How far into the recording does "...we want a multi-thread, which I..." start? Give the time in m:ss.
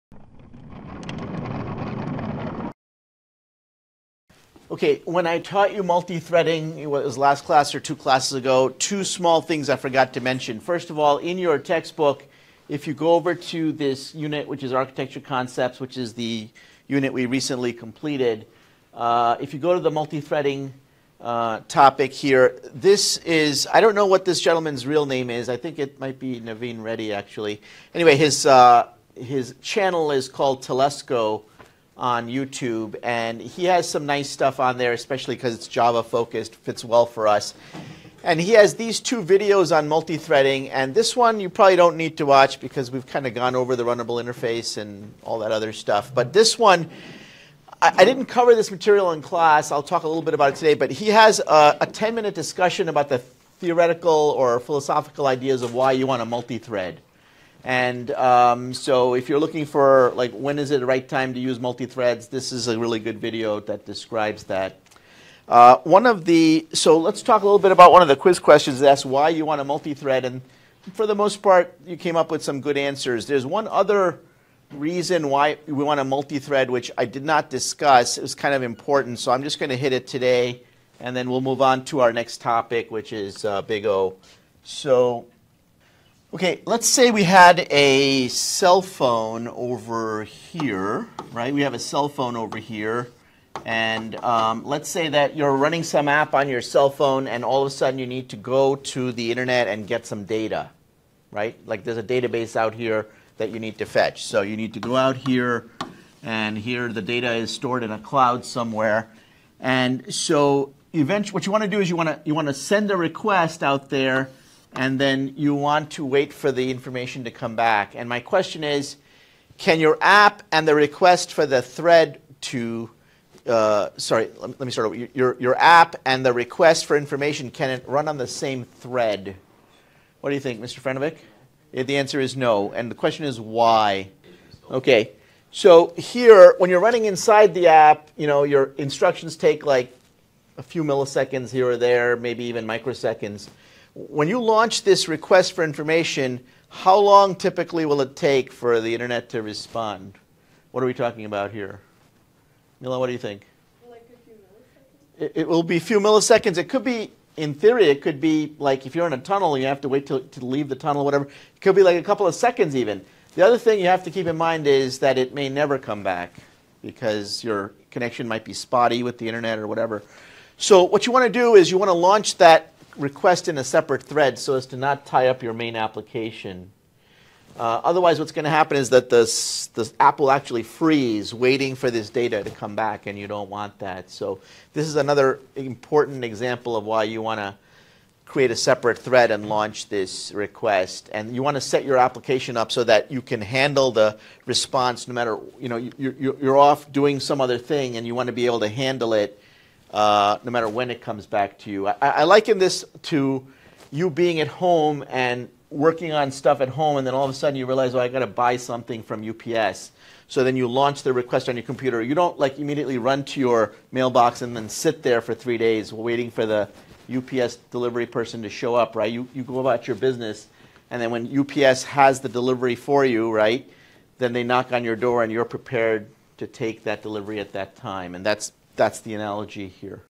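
1:15.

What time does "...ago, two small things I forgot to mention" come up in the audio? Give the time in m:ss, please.
0:08.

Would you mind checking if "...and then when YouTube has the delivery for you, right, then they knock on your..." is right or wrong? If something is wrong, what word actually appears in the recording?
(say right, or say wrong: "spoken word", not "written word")
wrong: "UPS", not "YouTube".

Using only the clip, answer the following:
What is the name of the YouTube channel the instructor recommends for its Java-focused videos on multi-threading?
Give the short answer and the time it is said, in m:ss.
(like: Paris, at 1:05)
Telusko, at 0:30.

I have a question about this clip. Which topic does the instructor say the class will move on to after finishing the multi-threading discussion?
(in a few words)
Big O.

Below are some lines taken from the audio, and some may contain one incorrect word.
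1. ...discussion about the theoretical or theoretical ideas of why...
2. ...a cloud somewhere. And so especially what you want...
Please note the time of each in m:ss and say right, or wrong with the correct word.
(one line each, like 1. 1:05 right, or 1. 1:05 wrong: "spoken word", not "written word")
1. 0:52 wrong: "philosophical", not "theoretical"
2. 1:47 wrong: "eventually", not "especially".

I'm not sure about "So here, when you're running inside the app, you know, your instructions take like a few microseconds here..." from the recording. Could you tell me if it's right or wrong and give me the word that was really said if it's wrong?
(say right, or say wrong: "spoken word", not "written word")
wrong: "milliseconds", not "microseconds".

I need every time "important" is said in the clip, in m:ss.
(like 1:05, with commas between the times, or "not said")
1:18, 3:05.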